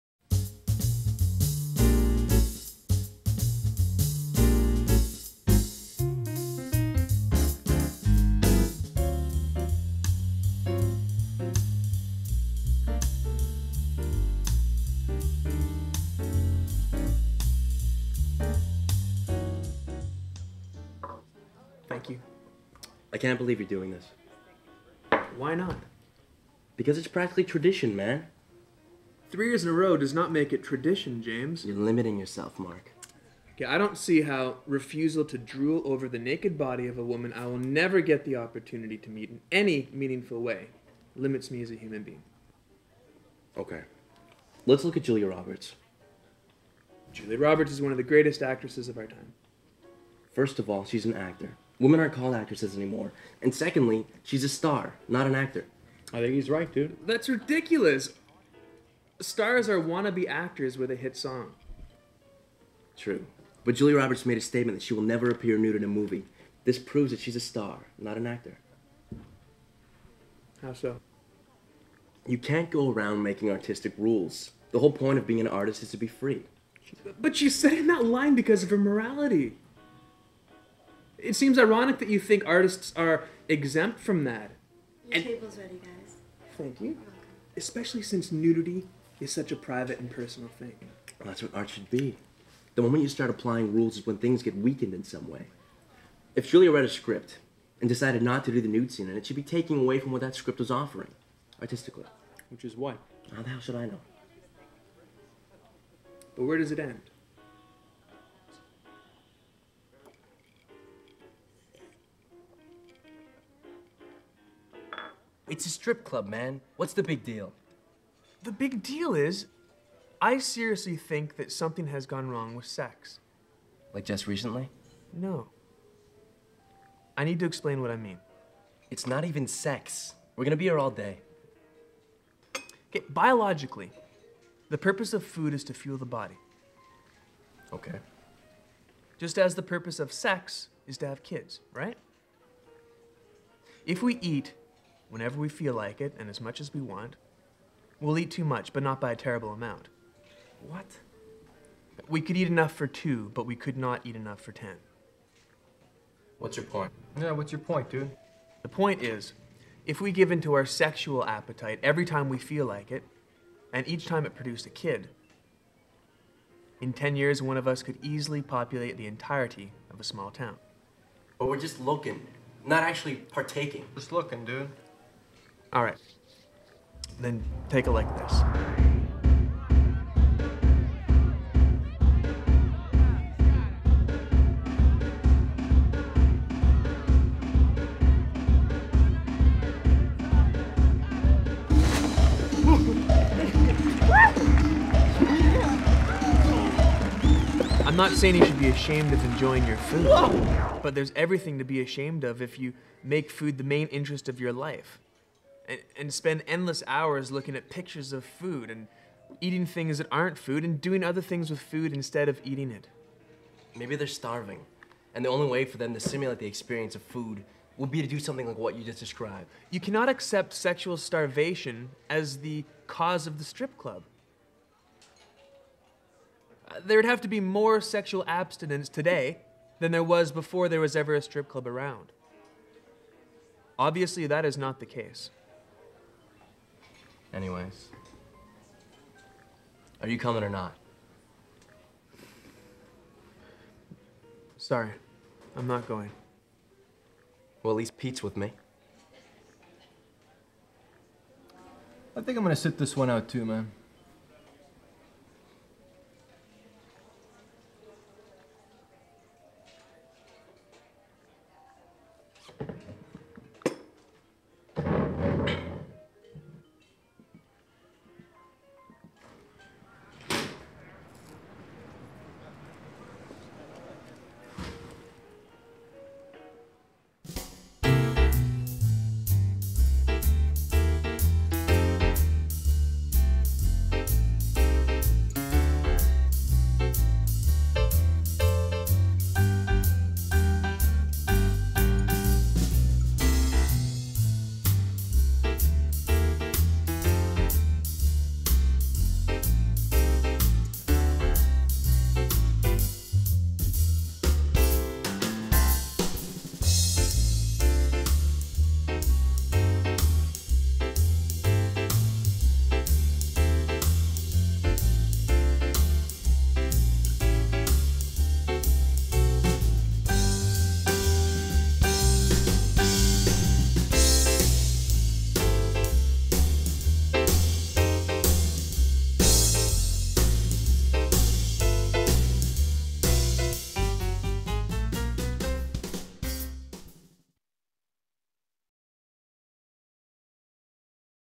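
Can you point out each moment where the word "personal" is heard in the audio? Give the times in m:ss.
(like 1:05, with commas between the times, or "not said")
1:30.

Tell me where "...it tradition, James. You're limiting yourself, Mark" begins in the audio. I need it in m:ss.
0:30.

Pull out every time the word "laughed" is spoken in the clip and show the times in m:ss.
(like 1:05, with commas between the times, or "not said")
not said.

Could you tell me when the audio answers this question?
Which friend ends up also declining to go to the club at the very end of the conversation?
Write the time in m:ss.
4:07.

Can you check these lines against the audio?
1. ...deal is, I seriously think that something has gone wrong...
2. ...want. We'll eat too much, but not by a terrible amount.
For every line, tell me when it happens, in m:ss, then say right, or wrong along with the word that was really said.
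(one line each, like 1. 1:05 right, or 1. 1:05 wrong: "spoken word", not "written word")
1. 1:58 right
2. 2:26 right.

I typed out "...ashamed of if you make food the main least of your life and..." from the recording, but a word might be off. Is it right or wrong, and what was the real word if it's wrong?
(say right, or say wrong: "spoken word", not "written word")
wrong: "interest", not "least".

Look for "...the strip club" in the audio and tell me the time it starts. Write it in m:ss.
3:43.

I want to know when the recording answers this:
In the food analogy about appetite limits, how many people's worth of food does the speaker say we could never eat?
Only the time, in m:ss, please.
2:34.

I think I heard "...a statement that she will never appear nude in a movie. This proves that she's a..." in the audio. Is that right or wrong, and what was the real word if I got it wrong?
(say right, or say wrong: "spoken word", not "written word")
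right.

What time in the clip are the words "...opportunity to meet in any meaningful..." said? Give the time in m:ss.
0:38.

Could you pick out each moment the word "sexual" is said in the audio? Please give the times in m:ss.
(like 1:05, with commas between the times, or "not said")
2:40, 3:40, 3:47.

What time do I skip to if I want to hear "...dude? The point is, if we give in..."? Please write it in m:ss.
2:37.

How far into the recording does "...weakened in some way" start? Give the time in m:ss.
1:34.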